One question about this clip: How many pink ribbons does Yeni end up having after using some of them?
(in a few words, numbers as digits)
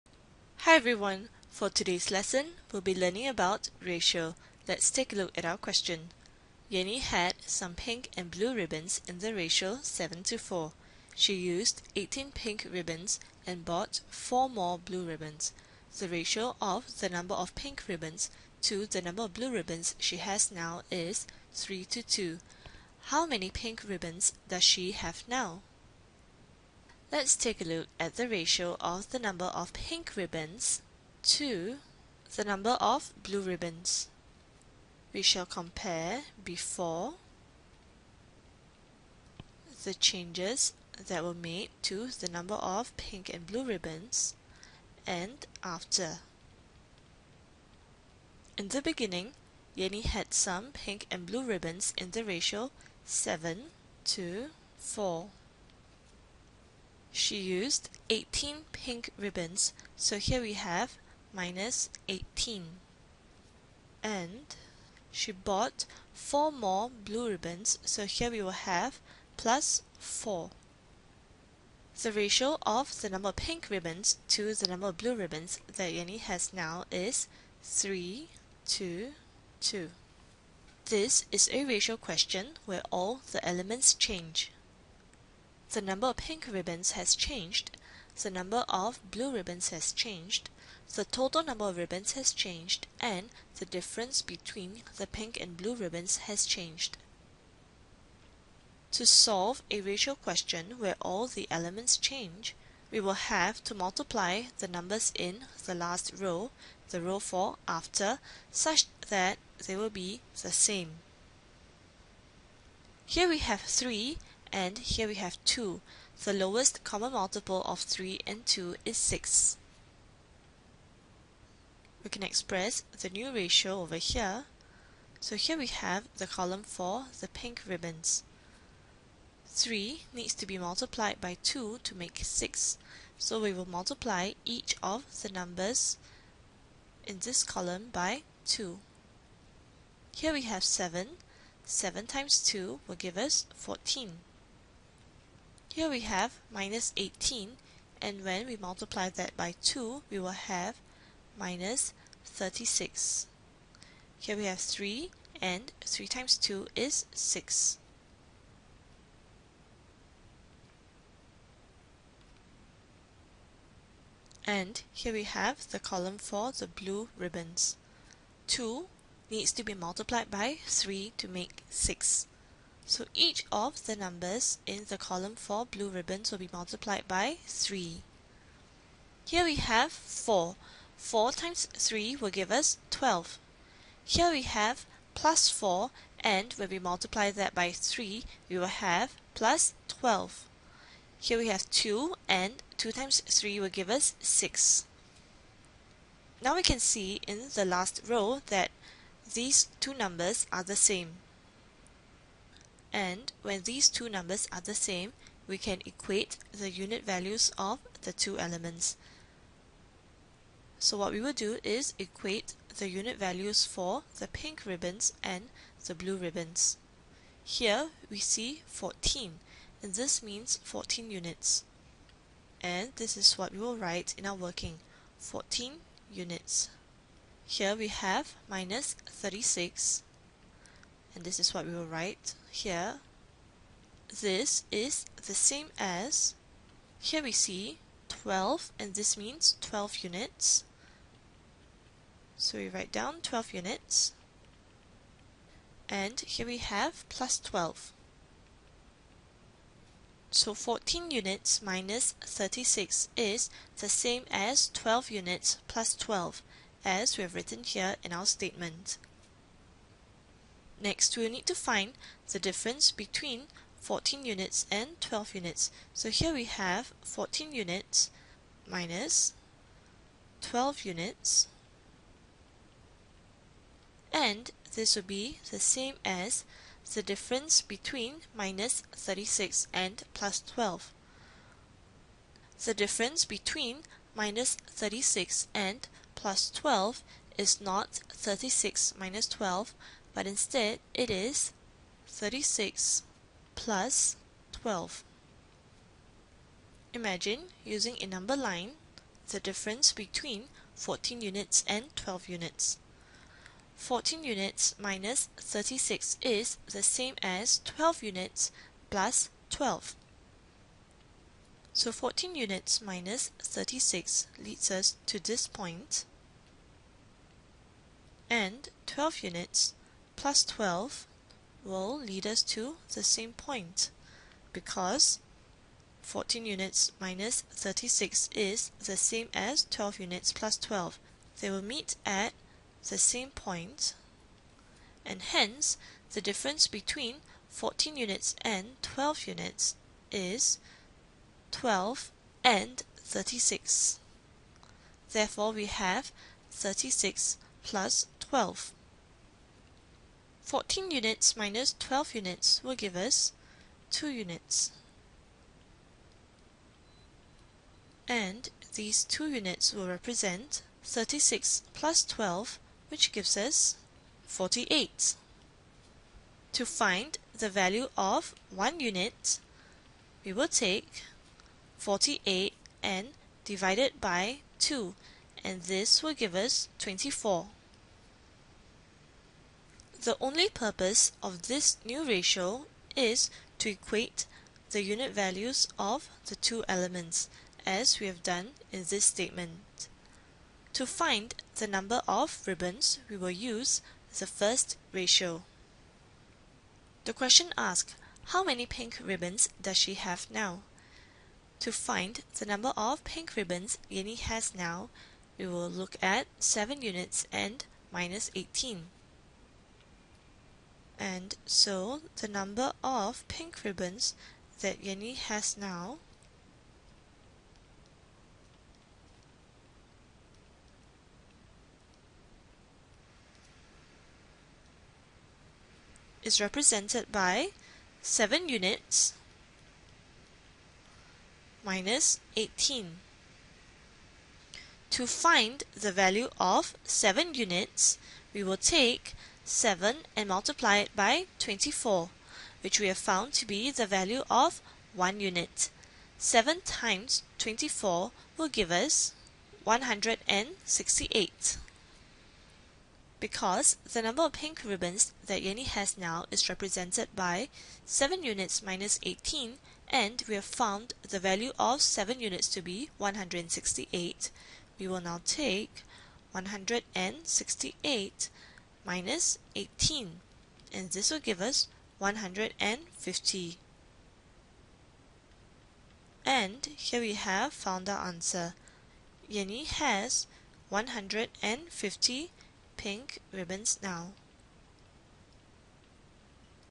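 150.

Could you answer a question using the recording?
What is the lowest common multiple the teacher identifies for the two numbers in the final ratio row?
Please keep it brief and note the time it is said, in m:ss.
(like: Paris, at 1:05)
6, at 1:56.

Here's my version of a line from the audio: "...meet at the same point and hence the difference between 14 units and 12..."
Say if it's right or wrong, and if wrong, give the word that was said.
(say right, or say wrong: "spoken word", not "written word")
right.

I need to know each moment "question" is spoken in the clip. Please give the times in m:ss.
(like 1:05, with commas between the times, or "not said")
0:05, 1:21, 1:40, 6:37.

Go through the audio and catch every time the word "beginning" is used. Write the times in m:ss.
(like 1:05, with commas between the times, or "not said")
0:48.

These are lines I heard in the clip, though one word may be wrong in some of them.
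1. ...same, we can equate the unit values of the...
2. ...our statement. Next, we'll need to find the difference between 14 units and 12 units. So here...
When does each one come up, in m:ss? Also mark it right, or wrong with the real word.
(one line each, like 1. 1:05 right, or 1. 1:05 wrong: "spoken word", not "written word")
1. 3:24 right
2. 4:18 right.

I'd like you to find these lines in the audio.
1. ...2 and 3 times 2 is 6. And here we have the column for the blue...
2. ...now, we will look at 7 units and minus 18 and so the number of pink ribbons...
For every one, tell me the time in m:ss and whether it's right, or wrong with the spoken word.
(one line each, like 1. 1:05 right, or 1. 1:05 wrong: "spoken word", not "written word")
1. 2:34 wrong: "3", not "2"
2. 6:44 right.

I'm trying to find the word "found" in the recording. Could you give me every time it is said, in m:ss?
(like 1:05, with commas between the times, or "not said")
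7:22, 7:40, 7:57.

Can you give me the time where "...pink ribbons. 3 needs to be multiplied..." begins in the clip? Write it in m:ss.
2:07.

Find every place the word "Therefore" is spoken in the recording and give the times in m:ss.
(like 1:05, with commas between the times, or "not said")
5:45.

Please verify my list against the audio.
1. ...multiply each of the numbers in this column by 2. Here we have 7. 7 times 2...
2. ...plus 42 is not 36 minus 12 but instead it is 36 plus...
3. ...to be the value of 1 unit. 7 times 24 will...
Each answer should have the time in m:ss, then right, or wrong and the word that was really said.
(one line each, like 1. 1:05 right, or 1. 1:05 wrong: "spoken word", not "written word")
1. 2:13 right
2. 4:46 wrong: "12", not "42"
3. 7:23 right.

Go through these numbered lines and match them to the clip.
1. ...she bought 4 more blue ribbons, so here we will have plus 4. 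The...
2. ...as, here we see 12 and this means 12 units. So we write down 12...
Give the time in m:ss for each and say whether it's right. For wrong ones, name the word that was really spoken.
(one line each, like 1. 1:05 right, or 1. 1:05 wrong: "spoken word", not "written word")
1. 1:05 right
2. 3:55 right.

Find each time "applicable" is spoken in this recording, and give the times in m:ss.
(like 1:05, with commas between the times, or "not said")
not said.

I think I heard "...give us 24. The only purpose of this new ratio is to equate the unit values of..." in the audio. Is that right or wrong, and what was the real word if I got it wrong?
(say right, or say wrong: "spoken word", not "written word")
right.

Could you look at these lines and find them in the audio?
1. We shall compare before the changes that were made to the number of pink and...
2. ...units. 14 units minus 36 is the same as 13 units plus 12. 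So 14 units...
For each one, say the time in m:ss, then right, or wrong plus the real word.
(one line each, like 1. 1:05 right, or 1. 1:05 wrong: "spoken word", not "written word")
1. 0:35 right
2. 5:02 wrong: "12", not "13".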